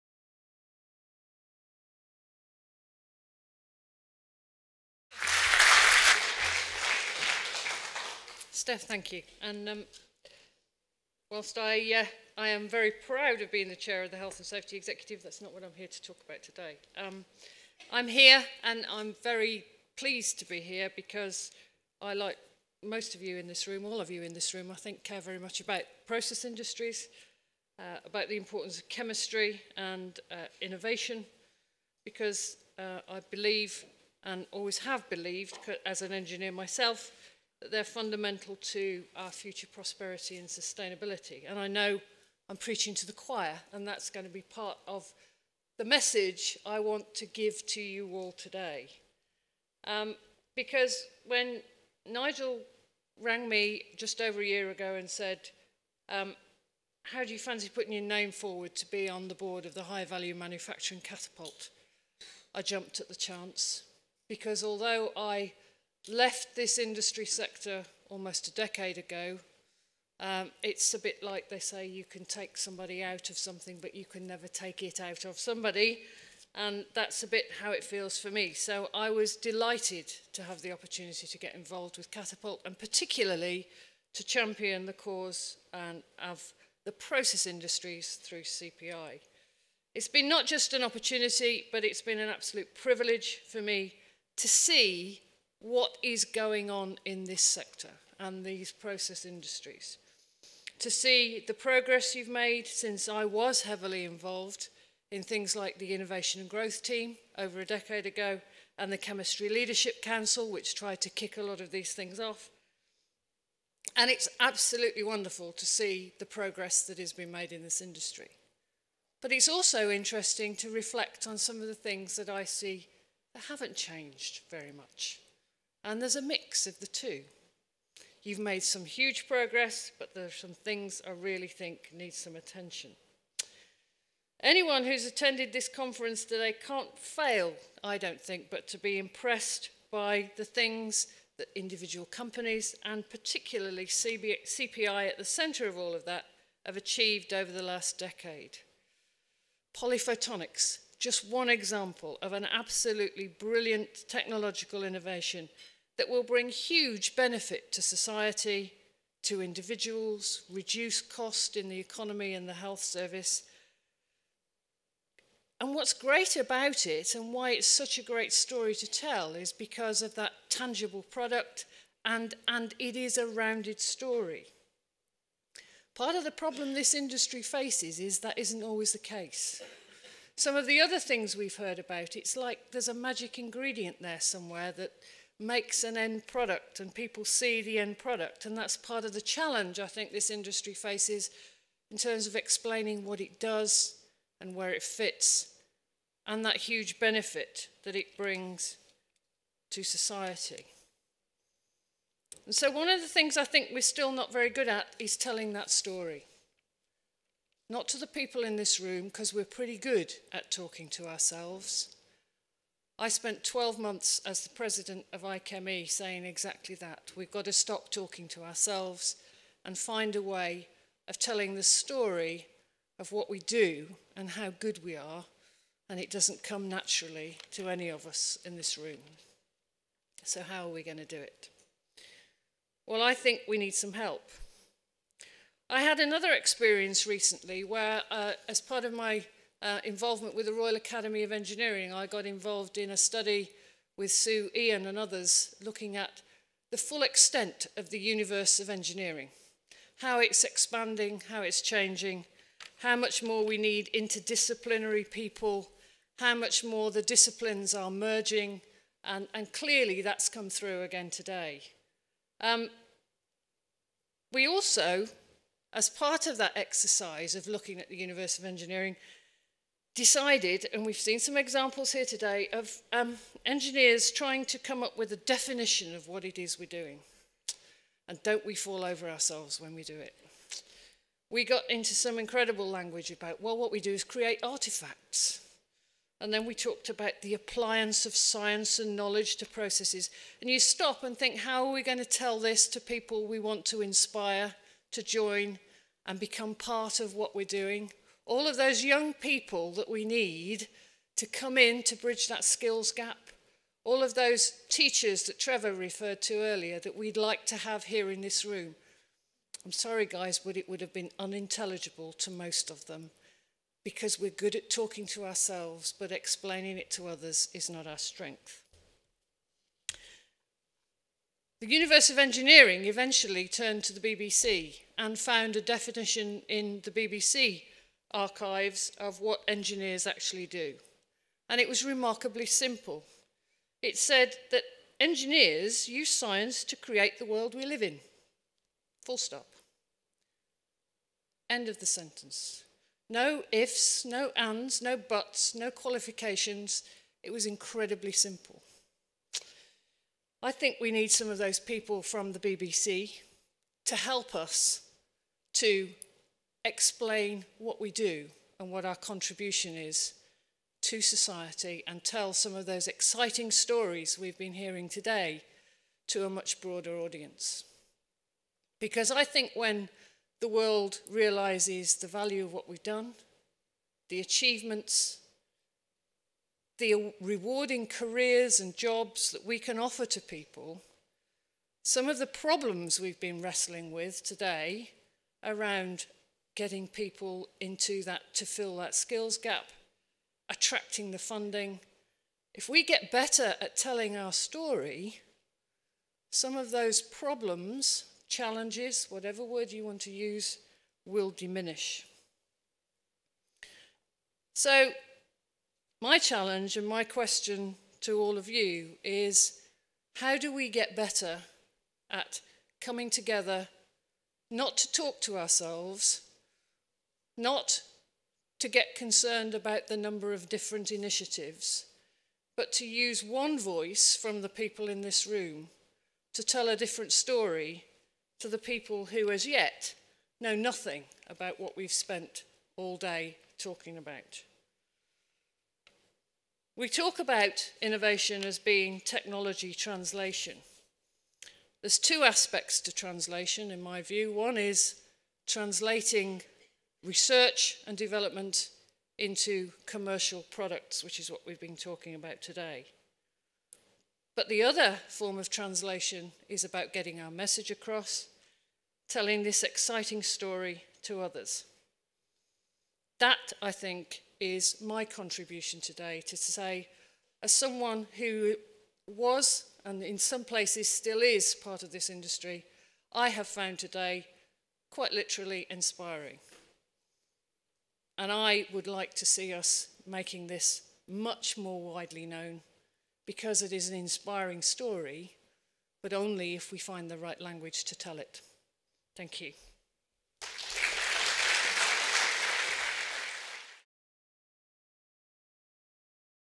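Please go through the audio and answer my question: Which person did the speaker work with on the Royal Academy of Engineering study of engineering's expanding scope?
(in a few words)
Sue Ion.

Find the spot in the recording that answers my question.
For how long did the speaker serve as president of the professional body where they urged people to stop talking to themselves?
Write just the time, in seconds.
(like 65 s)
213 s.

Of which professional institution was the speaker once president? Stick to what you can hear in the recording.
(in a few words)
IChemE.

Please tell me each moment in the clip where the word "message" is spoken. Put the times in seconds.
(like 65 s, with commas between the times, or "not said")
45 s, 457 s.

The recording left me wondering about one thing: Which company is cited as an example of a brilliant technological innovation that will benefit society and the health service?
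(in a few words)
PolyPhotonix.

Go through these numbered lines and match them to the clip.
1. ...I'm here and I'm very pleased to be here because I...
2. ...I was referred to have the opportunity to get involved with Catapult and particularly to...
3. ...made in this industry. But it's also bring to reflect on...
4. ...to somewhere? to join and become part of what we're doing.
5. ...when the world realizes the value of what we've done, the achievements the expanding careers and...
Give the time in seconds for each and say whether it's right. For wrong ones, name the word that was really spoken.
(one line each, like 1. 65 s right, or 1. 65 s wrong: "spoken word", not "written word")
1. 17 s right
2. 78 s wrong: "delighted", not "referred"
3. 117 s wrong: "interesting", not "bring"
4. 293 s wrong: "inspire", not "somewhere"
5. 369 s wrong: "rewarding", not "expanding".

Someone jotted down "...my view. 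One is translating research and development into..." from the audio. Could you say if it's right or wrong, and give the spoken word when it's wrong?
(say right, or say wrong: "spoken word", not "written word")
right.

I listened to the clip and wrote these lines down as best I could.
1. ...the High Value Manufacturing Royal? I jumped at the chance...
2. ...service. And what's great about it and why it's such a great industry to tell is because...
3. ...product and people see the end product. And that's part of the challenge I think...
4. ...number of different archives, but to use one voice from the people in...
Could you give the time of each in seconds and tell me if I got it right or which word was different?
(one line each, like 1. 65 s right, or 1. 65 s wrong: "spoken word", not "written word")
1. 59 s wrong: "Catapult", not "Royal"
2. 162 s wrong: "story", not "industry"
3. 186 s right
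4. 419 s wrong: "initiatives", not "archives".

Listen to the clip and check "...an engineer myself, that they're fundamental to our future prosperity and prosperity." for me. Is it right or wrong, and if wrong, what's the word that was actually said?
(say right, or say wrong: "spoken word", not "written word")
wrong: "sustainability", not "prosperity".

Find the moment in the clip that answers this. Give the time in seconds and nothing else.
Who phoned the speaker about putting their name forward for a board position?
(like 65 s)
52 s.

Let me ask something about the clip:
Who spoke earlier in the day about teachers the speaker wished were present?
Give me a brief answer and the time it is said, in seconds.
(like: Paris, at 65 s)
Trevor, at 305 s.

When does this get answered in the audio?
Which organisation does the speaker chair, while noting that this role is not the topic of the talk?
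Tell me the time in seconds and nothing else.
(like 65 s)
14 s.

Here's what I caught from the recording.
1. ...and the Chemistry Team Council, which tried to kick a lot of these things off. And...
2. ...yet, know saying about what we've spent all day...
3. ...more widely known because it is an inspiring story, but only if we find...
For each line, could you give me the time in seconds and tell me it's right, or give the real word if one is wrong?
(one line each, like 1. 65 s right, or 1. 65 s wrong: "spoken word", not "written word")
1. 108 s wrong: "Leadership", not "Team"
2. 429 s wrong: "nothing", not "saying"
3. 481 s right.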